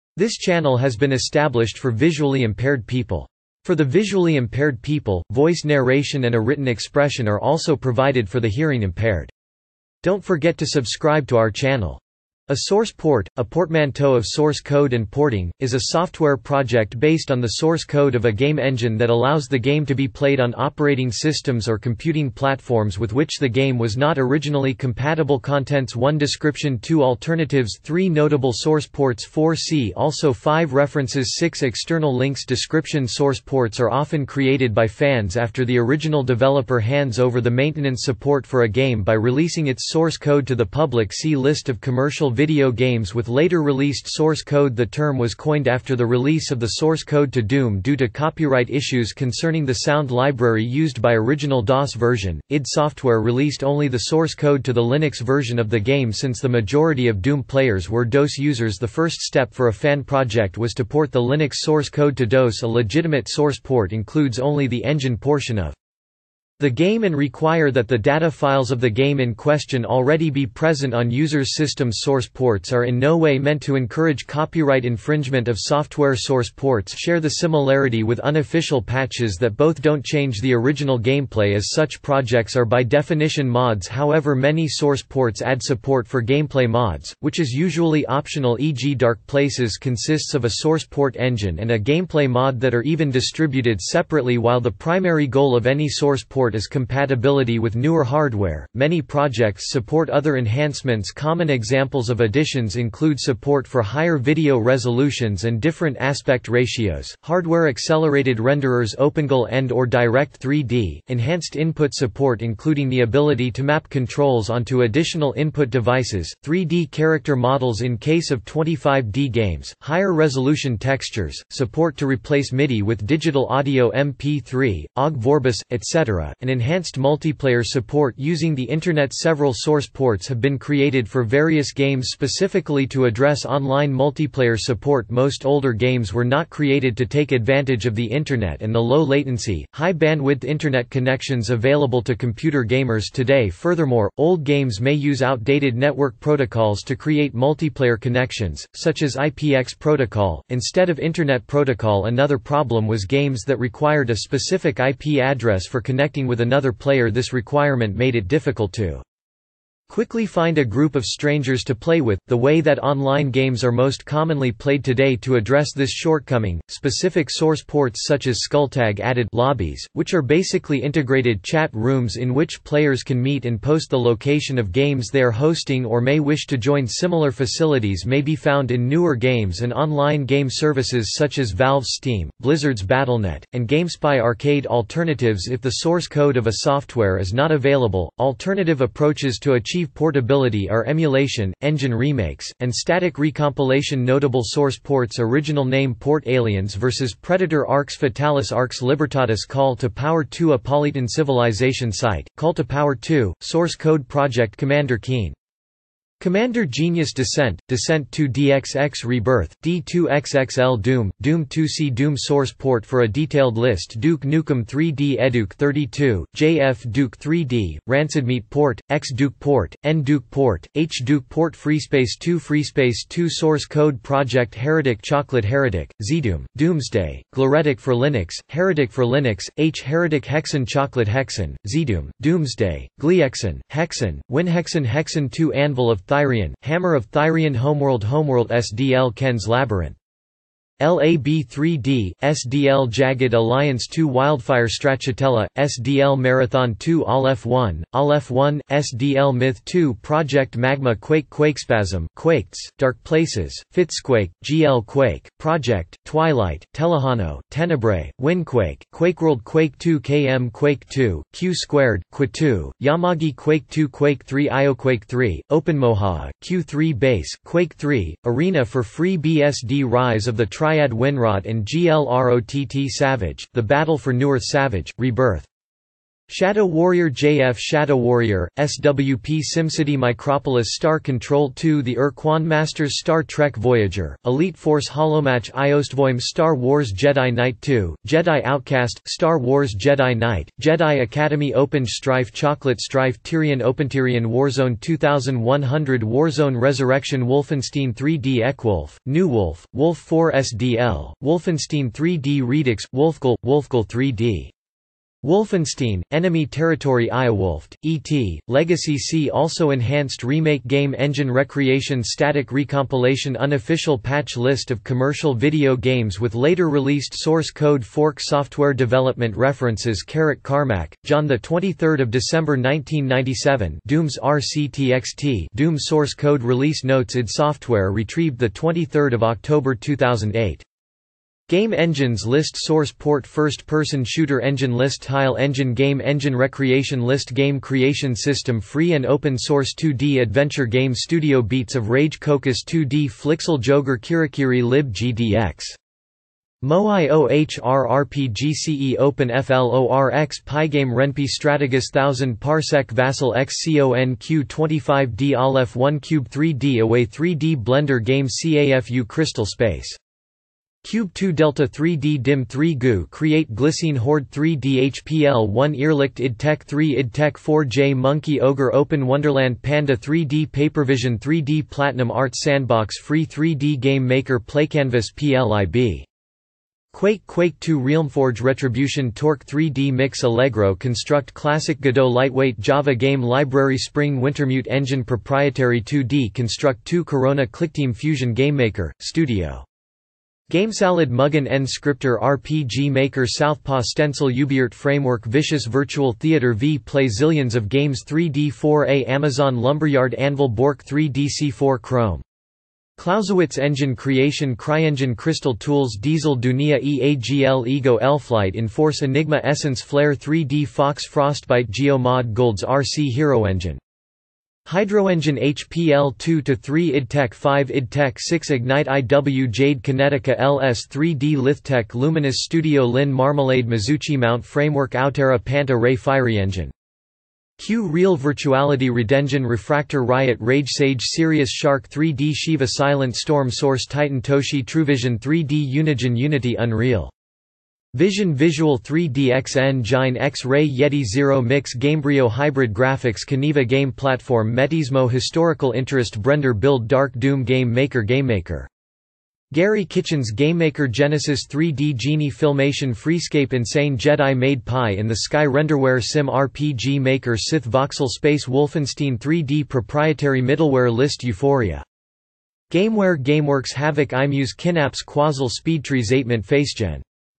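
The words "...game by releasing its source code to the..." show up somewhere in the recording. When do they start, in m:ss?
0:38.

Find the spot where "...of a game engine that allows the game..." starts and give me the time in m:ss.
0:18.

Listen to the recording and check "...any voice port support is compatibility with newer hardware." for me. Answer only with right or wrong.
wrong.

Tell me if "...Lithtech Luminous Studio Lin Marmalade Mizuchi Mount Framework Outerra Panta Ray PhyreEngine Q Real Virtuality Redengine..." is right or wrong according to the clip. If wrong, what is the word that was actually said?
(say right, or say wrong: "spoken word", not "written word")
right.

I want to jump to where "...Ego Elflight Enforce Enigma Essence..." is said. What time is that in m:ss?
6:47.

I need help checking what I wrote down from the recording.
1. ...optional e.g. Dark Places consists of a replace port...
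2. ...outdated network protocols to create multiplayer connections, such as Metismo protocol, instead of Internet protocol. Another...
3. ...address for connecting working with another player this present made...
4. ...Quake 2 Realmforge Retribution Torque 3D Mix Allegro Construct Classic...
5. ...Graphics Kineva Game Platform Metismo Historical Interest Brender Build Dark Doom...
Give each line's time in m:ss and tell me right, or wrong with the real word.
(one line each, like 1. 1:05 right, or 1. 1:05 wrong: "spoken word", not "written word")
1. 1:28 wrong: "source", not "replace"
2. 2:25 wrong: "IPX", not "Metismo"
3. 2:35 wrong: "requirement", not "present"
4. 6:17 right
5. 7:22 right.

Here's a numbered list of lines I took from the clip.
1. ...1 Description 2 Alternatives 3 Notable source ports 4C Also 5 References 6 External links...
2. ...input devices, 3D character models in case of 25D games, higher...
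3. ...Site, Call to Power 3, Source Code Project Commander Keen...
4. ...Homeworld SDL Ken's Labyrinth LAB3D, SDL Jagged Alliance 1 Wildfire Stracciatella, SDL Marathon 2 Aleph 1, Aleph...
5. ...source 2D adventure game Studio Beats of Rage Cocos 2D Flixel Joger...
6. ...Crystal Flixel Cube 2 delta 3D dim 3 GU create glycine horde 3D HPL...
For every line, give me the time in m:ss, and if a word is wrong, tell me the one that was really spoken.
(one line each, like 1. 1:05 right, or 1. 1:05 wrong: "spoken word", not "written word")
1. 0:25 right
2. 1:55 right
3. 3:21 wrong: "2", not "3"
4. 3:58 wrong: "2", not "1"
5. 5:39 right
6. 5:59 wrong: "Space", not "Flixel".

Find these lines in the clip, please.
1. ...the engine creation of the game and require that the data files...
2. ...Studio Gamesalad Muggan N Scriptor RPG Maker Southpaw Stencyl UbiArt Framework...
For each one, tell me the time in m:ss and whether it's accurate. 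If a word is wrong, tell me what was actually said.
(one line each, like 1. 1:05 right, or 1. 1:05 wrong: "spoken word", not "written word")
1. 1:04 wrong: "portion", not "creation"
2. 6:28 right.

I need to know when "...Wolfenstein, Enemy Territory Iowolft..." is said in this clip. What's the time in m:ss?
5:05.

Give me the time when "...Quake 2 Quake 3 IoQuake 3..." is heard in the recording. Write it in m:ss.
4:23.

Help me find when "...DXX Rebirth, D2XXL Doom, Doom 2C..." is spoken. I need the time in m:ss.
3:28.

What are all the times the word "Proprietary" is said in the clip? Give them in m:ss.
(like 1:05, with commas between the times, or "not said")
6:25, 7:39.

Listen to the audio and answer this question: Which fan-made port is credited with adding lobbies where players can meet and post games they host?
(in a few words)
Skulltag.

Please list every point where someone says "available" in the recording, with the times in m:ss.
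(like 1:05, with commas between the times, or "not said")
2:21, 3:07.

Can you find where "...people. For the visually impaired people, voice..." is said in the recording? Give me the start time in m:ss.
0:02.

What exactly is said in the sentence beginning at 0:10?
Don't forget to subscribe to our channel.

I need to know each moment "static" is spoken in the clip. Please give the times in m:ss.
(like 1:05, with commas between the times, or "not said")
3:12, 5:12.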